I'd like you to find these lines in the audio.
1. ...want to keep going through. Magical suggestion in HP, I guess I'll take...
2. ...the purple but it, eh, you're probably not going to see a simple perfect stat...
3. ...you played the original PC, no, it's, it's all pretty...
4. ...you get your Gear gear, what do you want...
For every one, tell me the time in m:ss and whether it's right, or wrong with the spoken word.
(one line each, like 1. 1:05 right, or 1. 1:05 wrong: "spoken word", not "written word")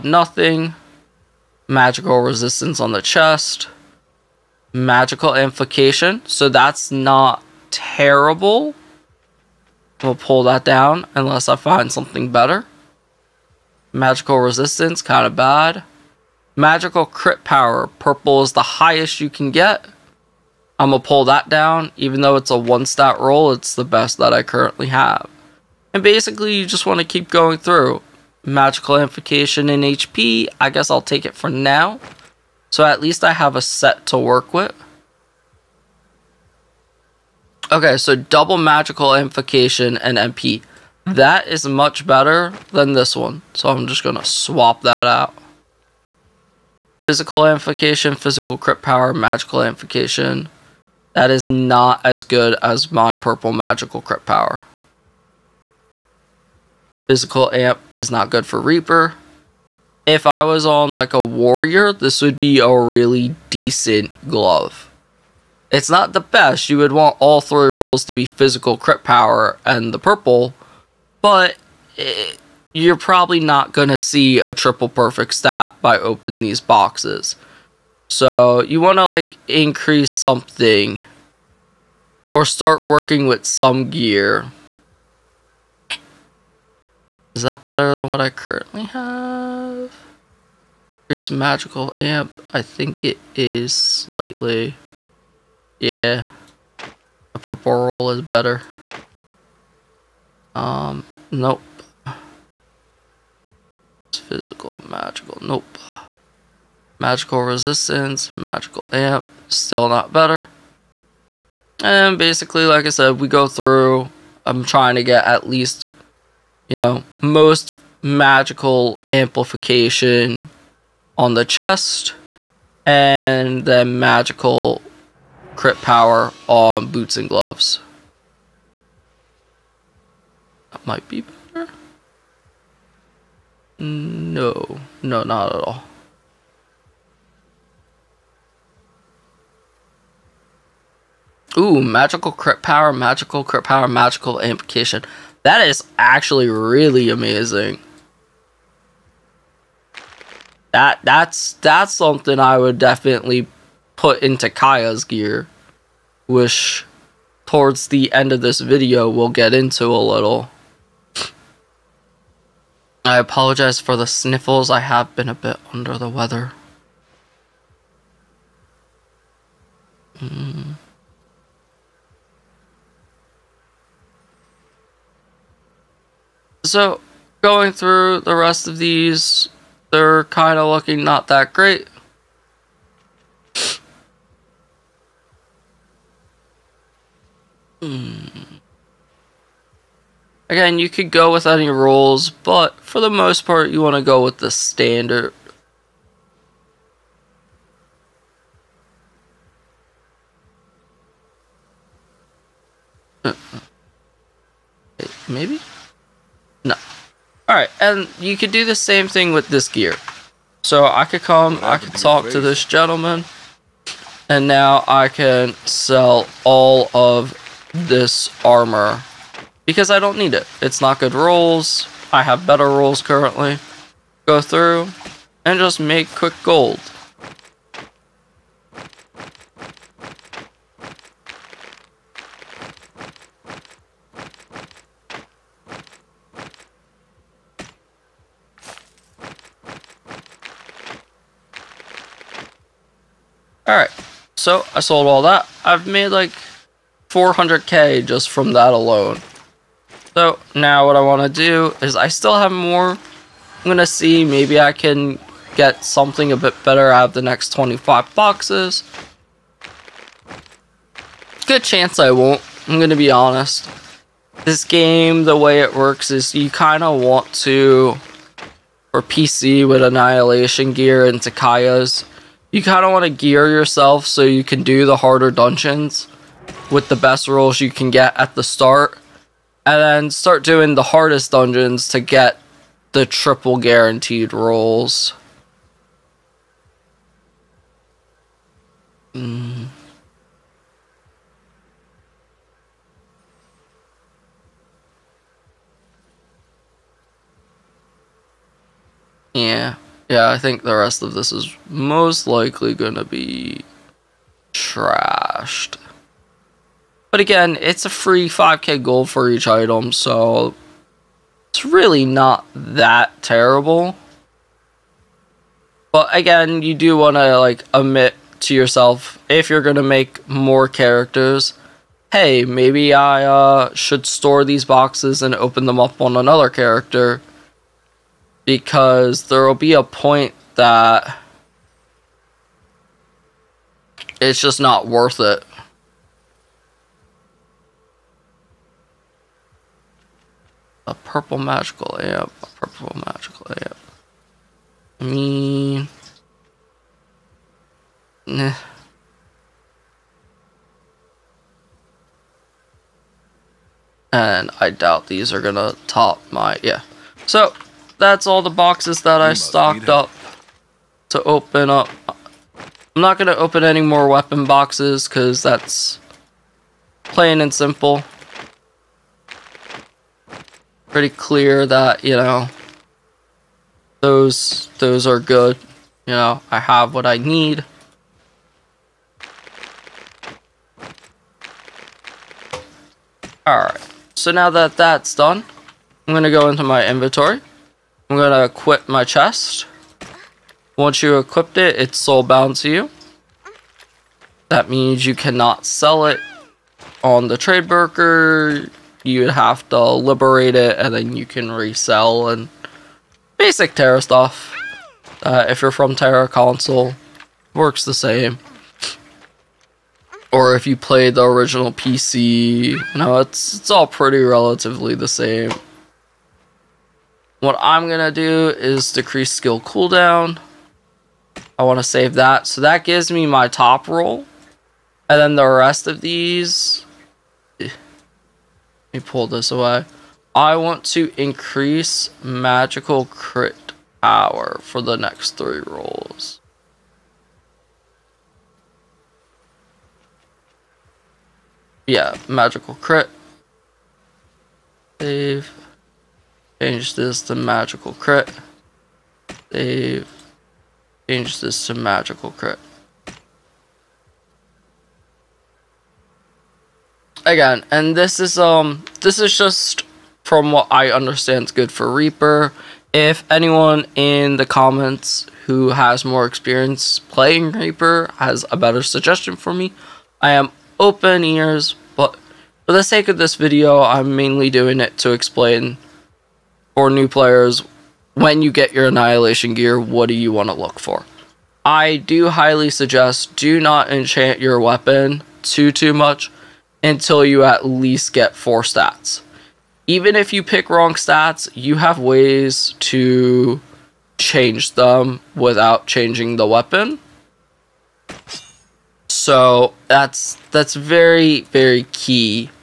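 1. 0:26 wrong: "amplification", not "suggestion"
2. 1:09 wrong: "triple", not "simple"
3. 6:50 right
4. 7:58 wrong: "Annihilation", not "Gear".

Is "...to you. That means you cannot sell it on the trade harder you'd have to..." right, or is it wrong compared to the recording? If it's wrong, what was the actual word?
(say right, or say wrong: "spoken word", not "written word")
wrong: "broker", not "harder".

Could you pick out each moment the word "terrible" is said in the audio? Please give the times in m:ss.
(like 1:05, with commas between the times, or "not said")
0:07, 5:13.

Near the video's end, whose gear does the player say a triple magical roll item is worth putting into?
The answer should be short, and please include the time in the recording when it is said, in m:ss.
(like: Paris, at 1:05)
Kaia's, at 2:34.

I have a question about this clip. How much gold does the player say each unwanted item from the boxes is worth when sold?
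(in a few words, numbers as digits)
5k gold.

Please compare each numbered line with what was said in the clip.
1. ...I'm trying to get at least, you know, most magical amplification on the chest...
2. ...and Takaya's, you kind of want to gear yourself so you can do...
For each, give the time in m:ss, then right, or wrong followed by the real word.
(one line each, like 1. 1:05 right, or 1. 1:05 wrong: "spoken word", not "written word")
1. 1:54 right
2. 4:31 right.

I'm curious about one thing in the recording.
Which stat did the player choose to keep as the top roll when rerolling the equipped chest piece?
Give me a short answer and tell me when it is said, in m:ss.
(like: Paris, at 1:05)
Decrease skill cooldown, at 6:58.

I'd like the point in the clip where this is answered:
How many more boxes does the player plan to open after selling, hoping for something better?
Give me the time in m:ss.
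4:17.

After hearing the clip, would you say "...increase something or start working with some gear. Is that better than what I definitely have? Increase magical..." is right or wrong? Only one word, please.
wrong.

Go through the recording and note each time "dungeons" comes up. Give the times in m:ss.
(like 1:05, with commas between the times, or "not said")
4:35, 4:41.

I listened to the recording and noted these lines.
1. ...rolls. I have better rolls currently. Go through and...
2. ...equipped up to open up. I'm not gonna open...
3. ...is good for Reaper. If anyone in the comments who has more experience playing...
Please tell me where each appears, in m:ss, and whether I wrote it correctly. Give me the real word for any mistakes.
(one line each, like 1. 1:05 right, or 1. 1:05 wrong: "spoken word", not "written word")
1. 3:41 right
2. 5:59 wrong: "stocked", not "equipped"
3. 7:41 right.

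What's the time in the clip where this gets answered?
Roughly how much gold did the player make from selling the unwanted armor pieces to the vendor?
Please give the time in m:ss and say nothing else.
4:07.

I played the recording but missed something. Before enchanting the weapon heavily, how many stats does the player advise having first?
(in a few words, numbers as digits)
4.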